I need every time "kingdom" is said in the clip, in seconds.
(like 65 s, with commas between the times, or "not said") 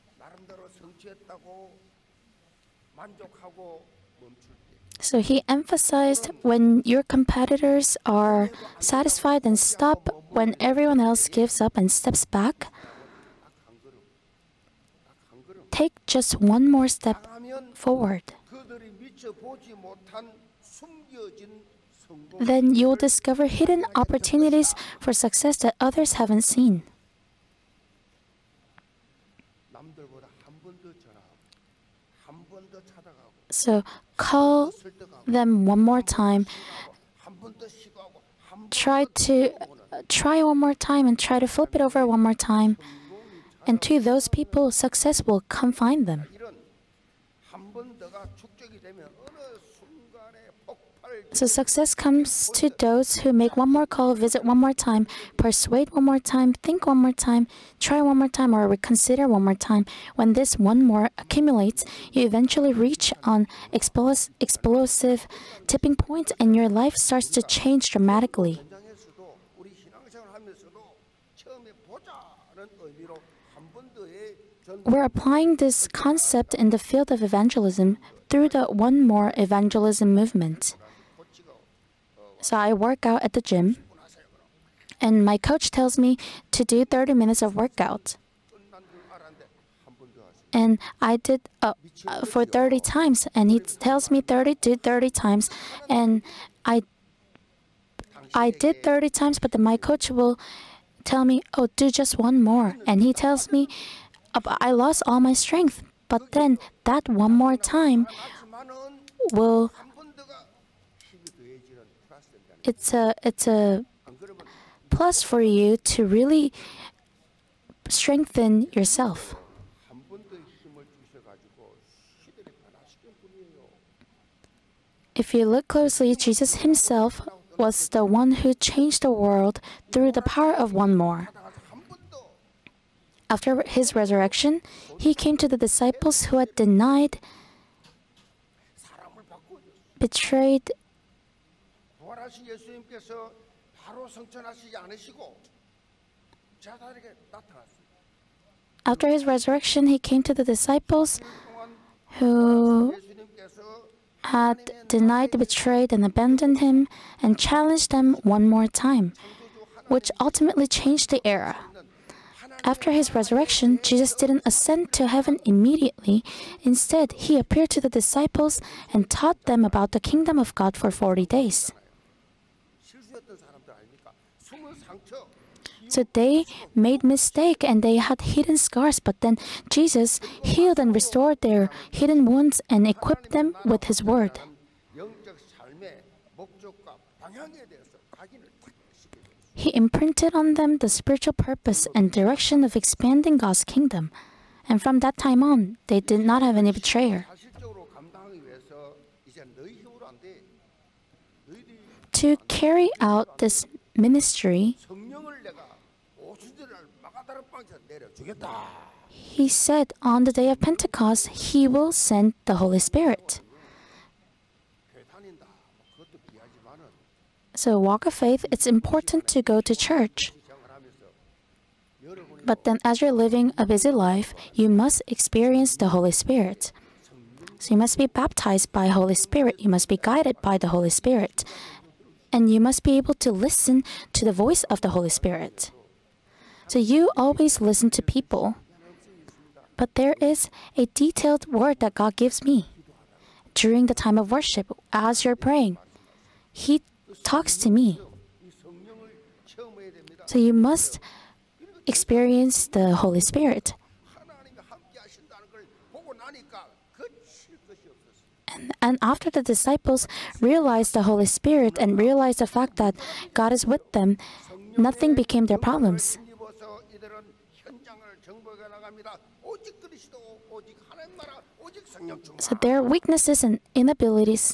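169 s, 193 s.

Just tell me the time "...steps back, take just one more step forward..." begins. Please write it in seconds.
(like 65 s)
11 s.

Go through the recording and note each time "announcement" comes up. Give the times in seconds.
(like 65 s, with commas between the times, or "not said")
not said.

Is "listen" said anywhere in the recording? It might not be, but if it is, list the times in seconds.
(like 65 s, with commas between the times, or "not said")
233 s, 237 s.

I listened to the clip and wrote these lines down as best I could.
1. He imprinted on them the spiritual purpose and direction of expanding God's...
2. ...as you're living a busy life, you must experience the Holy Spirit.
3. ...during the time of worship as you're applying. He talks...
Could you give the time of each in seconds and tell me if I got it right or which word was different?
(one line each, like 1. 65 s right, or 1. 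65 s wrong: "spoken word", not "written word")
1. 189 s right
2. 222 s right
3. 243 s wrong: "praying", not "applying".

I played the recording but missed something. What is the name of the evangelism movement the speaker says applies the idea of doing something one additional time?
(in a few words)
One More Evangelism.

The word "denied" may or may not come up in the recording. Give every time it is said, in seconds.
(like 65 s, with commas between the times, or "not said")
136 s, 154 s.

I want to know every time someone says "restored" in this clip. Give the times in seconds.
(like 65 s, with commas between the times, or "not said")
180 s.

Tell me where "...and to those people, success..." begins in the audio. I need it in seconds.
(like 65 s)
43 s.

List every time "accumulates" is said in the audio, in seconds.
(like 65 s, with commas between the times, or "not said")
61 s.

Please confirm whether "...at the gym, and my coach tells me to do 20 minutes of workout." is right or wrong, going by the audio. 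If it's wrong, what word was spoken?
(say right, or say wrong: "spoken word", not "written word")
wrong: "30", not "20".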